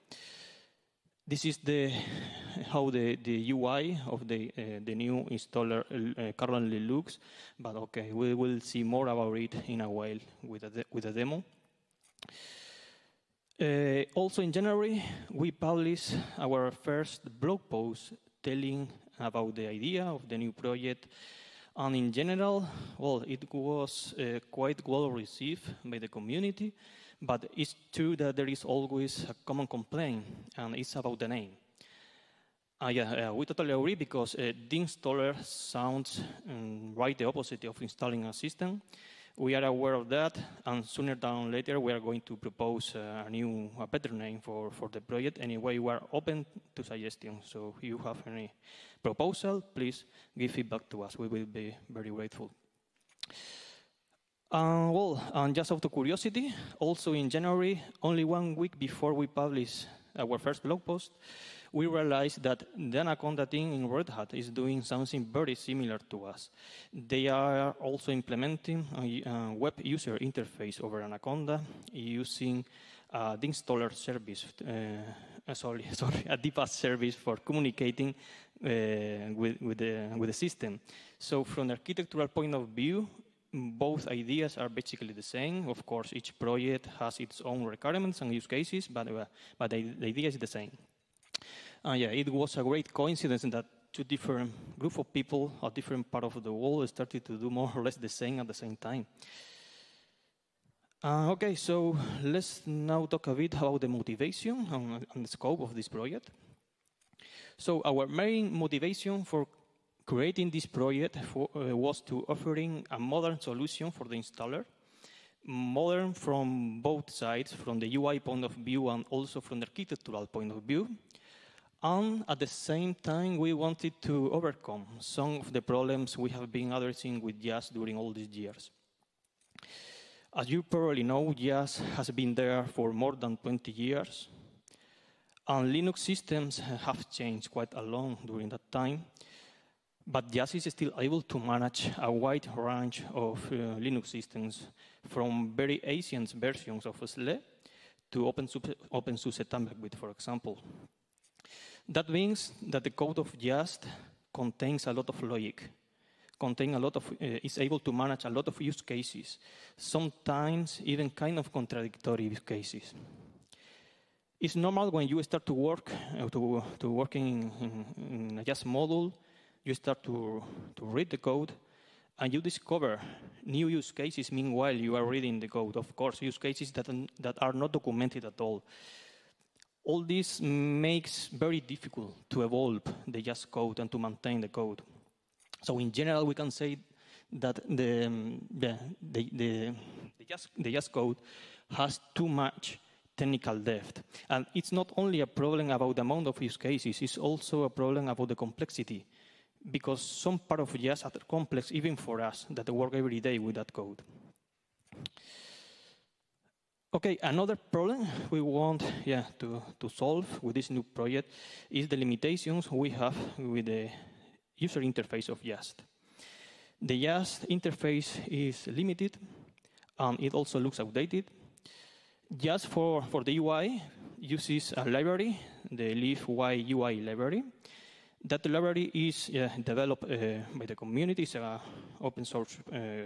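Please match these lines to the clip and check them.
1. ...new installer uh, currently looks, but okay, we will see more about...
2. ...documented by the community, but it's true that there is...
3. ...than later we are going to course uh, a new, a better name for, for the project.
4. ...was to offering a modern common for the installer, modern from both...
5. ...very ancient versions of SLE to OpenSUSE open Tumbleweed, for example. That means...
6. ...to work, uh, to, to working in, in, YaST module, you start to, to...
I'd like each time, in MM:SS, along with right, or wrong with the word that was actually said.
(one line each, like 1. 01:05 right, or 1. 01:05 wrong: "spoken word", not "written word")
1. 00:04 right
2. 00:25 wrong: "received", not "documented"
3. 00:41 wrong: "propose", not "course"
4. 01:51 wrong: "solution", not "common"
5. 02:25 right
6. 02:45 right.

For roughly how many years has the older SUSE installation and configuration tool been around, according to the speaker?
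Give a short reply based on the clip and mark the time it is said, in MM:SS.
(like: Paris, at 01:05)
more than 20 years, at 02:12.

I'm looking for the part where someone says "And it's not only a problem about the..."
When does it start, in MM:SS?
03:14.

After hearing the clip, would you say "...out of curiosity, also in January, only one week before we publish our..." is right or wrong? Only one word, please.
right.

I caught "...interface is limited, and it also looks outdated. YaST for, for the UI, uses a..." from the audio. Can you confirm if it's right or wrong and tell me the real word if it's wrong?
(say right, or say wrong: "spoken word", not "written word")
right.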